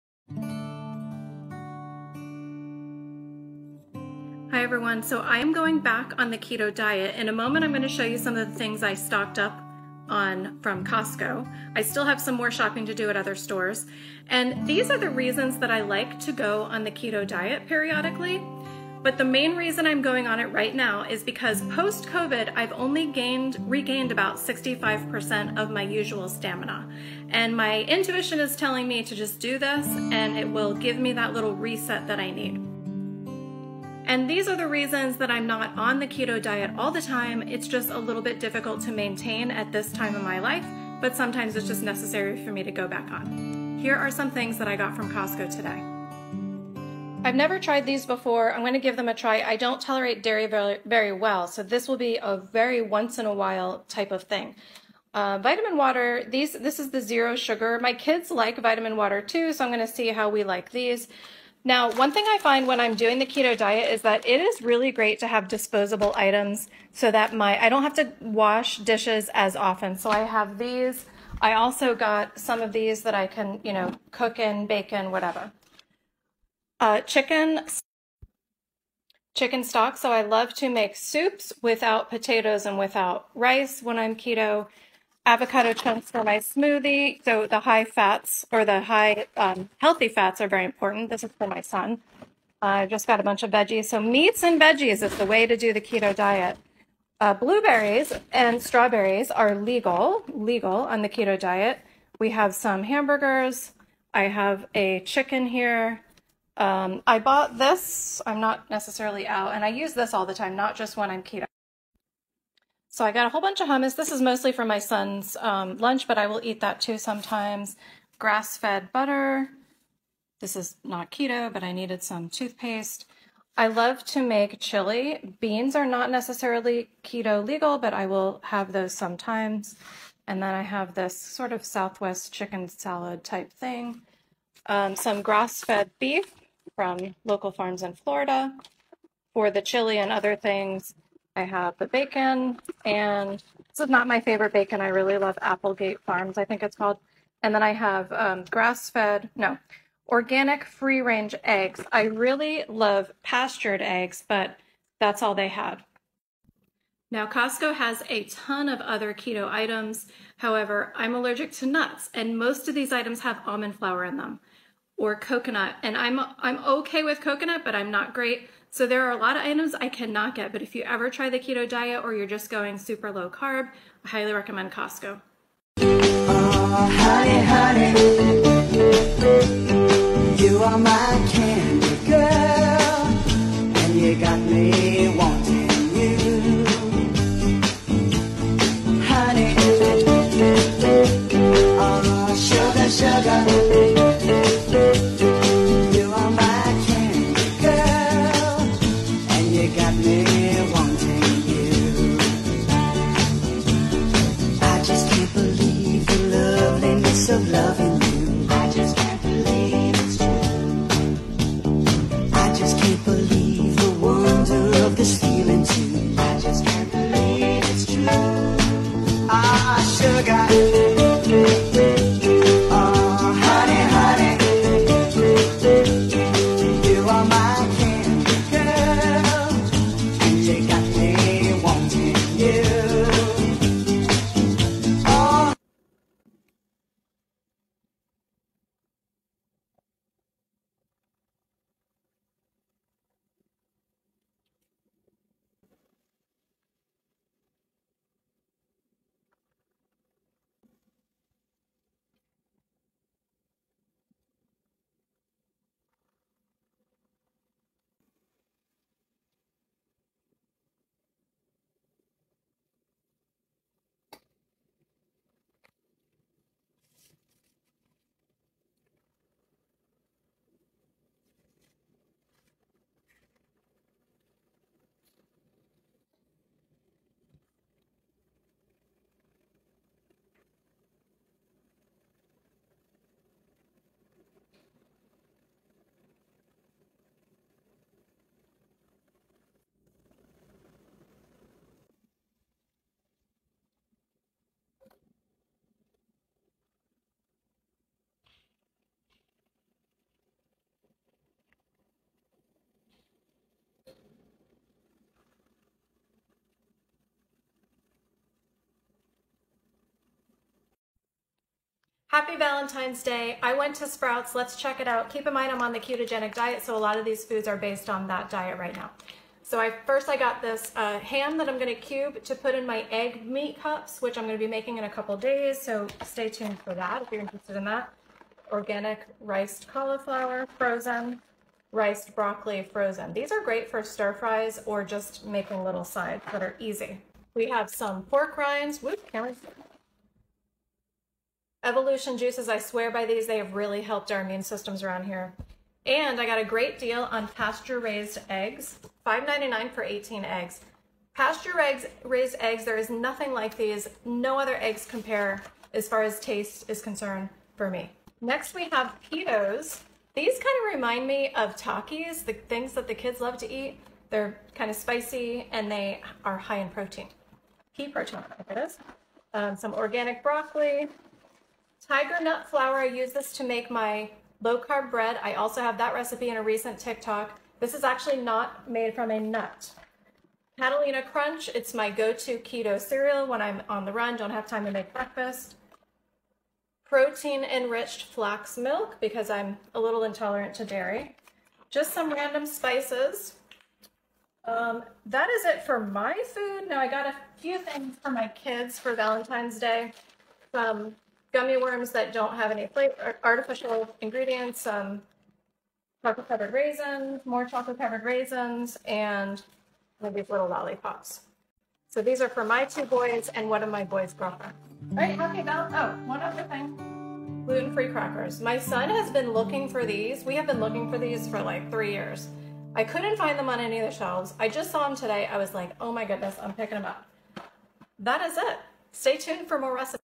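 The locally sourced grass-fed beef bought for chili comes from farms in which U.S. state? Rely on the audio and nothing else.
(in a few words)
Florida.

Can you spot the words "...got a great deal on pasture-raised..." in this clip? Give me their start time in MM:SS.
05:46.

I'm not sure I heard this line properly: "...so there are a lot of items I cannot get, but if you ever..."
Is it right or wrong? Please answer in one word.
right.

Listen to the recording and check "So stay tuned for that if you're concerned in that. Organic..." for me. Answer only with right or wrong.
wrong.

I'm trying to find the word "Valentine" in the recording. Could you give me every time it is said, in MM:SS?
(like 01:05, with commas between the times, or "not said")
05:12, 06:38.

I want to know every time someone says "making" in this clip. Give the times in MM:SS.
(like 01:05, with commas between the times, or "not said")
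05:24, 05:35.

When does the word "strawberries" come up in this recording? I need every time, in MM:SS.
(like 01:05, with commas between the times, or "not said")
01:38.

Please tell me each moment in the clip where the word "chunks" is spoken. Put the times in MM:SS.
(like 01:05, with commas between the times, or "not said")
01:25.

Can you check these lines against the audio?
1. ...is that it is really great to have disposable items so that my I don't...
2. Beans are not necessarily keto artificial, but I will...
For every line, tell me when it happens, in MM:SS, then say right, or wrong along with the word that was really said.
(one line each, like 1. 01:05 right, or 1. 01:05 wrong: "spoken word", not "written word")
1. 01:03 right
2. 02:05 wrong: "legal", not "artificial".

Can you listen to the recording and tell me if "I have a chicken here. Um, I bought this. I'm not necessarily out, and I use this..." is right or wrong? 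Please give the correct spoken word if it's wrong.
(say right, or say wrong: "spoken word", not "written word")
right.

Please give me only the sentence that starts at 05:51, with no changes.
Pasture-raised eggs, there is nothing like these.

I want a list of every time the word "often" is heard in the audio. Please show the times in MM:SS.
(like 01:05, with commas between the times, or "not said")
01:09.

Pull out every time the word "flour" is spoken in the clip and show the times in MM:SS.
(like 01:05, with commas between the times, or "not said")
02:43, 06:12.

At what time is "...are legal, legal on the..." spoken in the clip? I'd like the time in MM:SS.
01:39.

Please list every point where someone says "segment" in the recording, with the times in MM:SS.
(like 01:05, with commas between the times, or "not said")
not said.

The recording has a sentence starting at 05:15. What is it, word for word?
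Keep in mind I'm on the ketogenic diet, so a lot of these foods are based on that diet right now.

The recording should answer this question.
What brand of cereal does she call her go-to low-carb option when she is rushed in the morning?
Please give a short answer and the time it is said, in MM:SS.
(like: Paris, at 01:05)
Catalina Crunch, at 06:20.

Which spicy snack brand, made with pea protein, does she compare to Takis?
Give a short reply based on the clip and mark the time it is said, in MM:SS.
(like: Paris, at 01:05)
Peatos, at 05:59.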